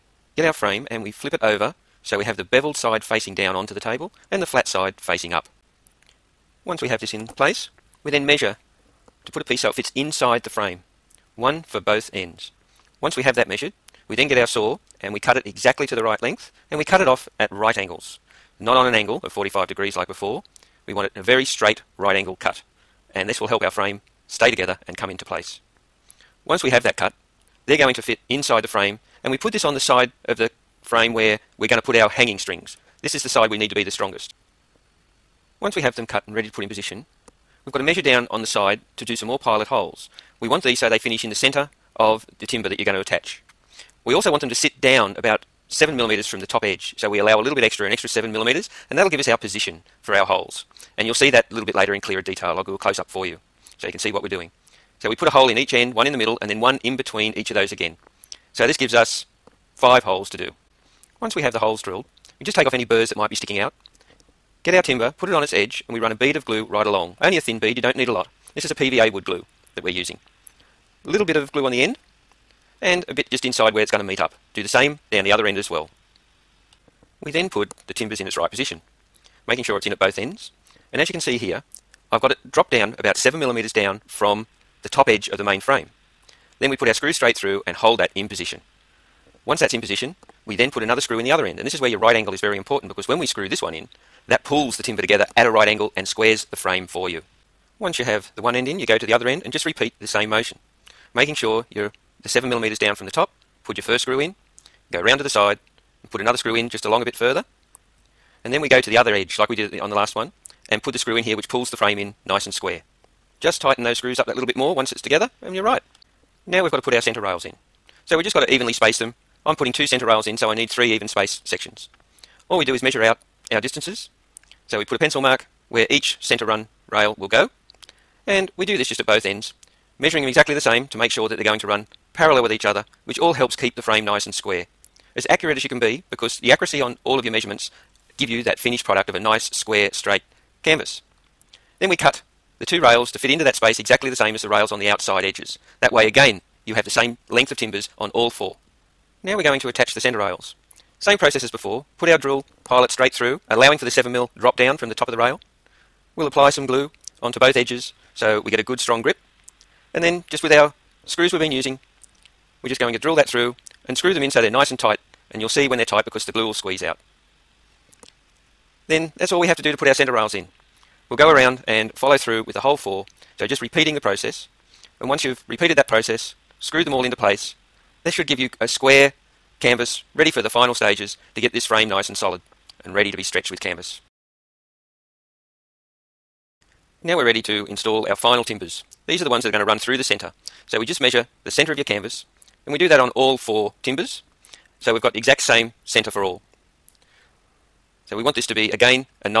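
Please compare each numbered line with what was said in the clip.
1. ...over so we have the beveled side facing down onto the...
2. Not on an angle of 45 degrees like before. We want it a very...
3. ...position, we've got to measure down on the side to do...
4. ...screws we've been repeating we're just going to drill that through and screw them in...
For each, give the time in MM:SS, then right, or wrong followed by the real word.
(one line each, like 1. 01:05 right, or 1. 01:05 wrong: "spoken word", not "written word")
1. 00:01 right
2. 00:18 right
3. 00:36 right
4. 02:41 wrong: "using", not "repeating".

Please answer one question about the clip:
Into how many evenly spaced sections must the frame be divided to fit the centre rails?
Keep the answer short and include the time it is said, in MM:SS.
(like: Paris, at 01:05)
3, at 02:00.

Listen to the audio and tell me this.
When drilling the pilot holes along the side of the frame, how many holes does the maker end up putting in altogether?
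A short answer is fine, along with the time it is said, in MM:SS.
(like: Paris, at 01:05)
5, at 00:59.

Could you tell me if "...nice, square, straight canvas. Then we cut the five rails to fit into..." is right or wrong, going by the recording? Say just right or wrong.
wrong.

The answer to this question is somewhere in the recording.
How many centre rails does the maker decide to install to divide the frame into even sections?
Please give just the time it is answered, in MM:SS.
01:59.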